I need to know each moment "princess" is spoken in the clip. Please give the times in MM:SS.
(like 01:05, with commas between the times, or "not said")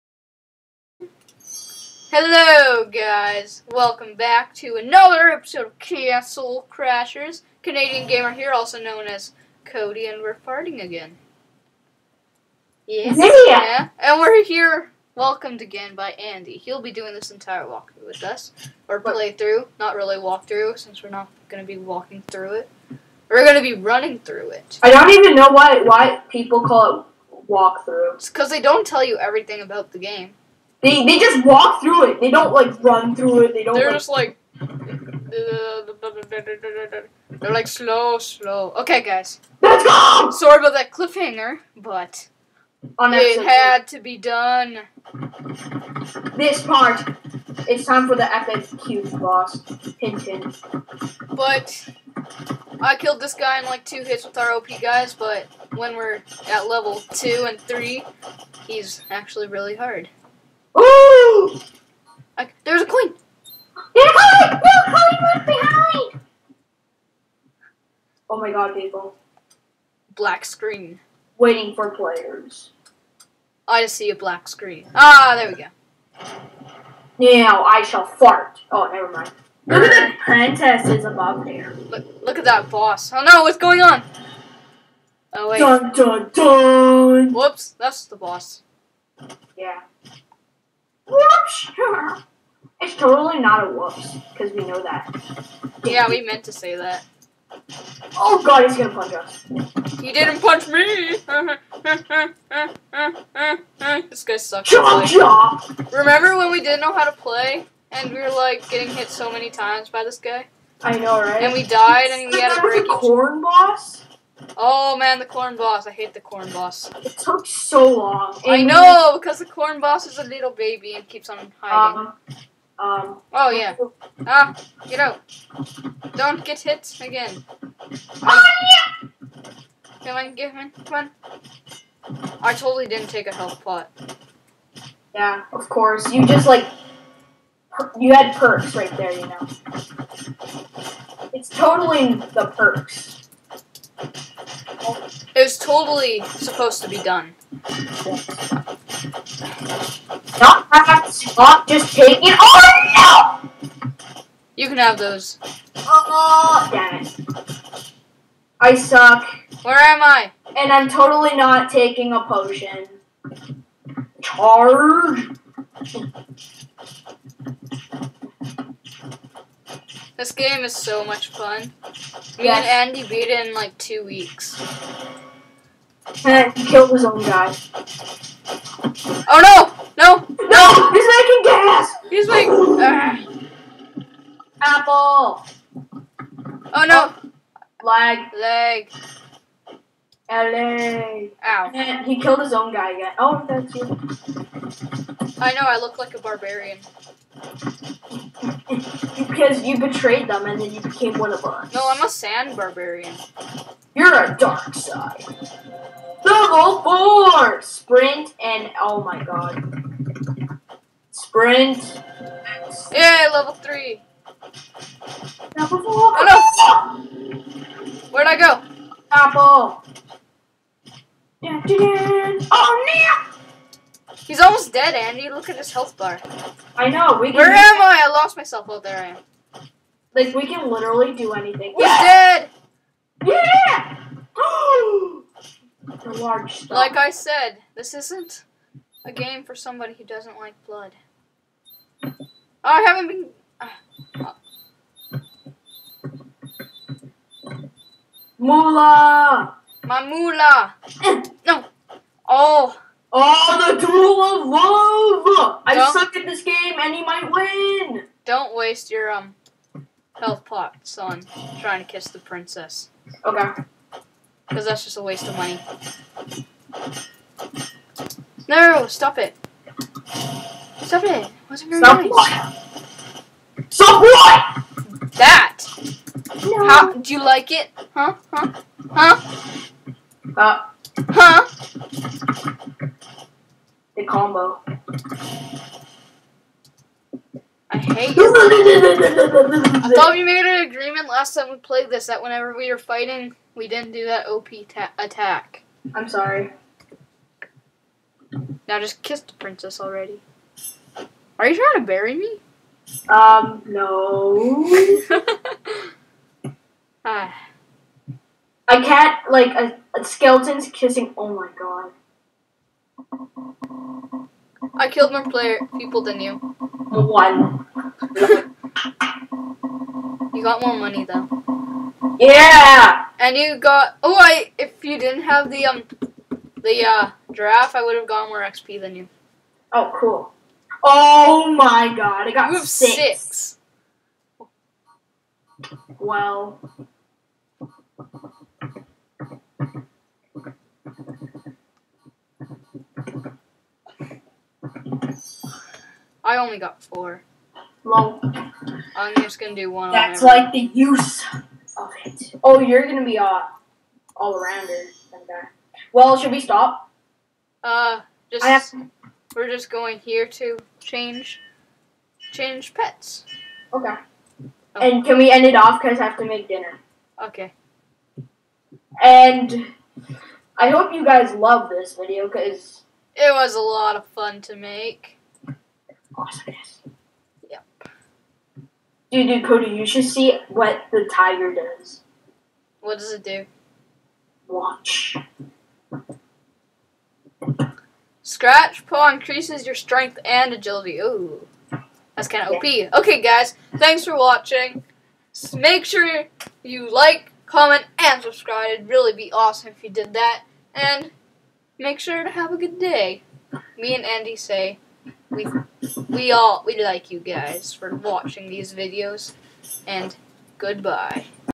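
01:20, 04:22, 04:59.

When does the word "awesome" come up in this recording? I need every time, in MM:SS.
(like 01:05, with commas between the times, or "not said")
06:16, 06:39.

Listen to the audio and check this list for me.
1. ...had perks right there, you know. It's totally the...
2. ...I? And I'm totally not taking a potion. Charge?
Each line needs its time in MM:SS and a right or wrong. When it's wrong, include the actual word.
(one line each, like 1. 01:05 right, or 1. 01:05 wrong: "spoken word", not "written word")
1. 02:18 right
2. 02:40 right.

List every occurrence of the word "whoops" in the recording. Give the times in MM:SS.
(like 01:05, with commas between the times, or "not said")
01:27, 01:33.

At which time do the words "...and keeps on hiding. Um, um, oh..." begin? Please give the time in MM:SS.
02:00.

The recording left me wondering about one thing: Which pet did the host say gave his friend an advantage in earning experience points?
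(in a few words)
Giraffe.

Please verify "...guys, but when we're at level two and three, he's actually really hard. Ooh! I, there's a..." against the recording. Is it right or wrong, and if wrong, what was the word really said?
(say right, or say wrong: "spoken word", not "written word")
right.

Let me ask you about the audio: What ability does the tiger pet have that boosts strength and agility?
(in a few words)
Scratch Paw.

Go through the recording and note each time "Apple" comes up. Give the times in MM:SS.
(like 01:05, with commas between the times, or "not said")
03:04, 03:39.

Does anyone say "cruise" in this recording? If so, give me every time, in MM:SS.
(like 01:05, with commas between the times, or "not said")
not said.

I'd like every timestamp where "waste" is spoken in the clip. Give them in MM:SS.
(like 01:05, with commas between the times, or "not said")
04:18, 04:25.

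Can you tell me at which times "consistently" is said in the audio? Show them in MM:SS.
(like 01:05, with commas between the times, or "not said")
not said.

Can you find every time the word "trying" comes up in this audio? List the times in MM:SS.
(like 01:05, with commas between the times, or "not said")
04:21, 05:01.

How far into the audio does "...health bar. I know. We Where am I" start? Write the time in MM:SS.
03:45.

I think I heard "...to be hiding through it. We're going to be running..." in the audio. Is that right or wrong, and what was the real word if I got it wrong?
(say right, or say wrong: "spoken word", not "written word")
wrong: "walking", not "hiding".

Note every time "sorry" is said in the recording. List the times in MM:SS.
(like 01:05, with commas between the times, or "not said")
00:40, 04:56.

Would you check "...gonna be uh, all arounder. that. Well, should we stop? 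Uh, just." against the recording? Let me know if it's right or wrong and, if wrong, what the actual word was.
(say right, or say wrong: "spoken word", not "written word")
right.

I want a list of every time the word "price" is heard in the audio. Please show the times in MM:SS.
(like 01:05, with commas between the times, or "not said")
not said.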